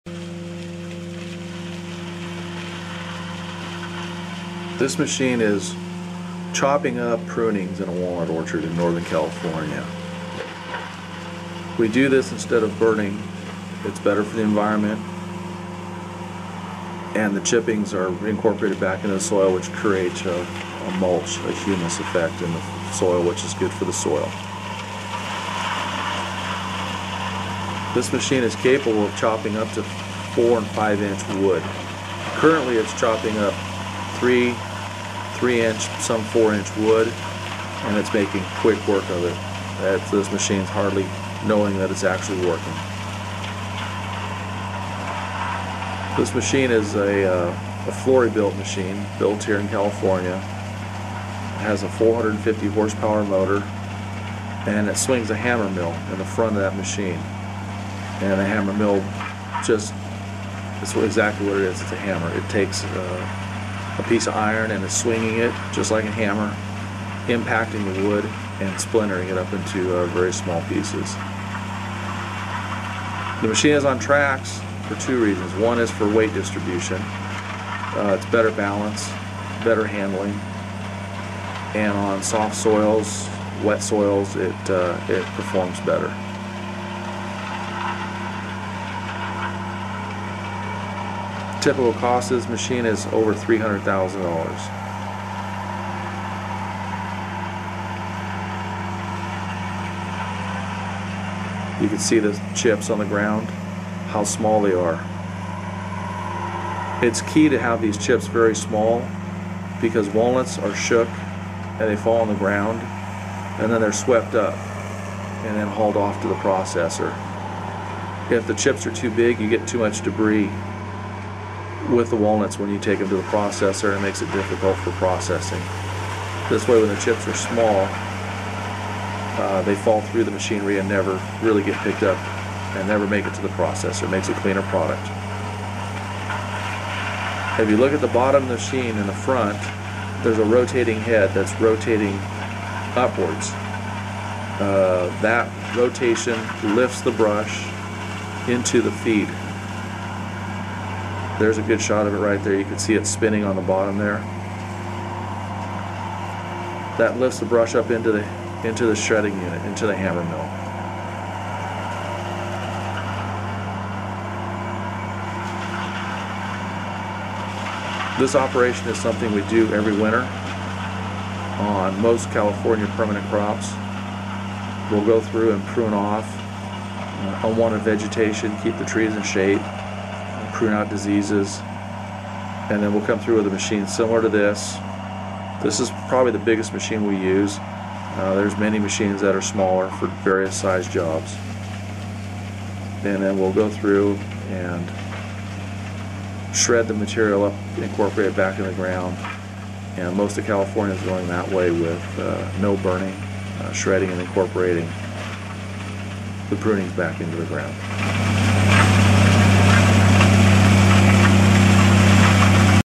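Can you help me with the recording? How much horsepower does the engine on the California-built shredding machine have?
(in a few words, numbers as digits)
450.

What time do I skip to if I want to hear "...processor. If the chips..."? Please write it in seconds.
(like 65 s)
116 s.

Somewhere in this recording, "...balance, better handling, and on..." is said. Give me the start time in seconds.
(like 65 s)
78 s.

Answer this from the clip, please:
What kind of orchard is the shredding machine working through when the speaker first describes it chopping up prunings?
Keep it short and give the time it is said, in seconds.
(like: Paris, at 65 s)
Walnut, at 7 s.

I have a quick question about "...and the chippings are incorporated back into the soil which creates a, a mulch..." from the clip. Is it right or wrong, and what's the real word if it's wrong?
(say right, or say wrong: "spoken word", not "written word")
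right.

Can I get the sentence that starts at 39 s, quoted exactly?
That's, this machine's hardly knowing that it's actually working.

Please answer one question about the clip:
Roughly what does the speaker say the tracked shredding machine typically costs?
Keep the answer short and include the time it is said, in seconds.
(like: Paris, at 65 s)
Over $300,000, at 93 s.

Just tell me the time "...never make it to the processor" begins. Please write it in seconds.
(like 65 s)
132 s.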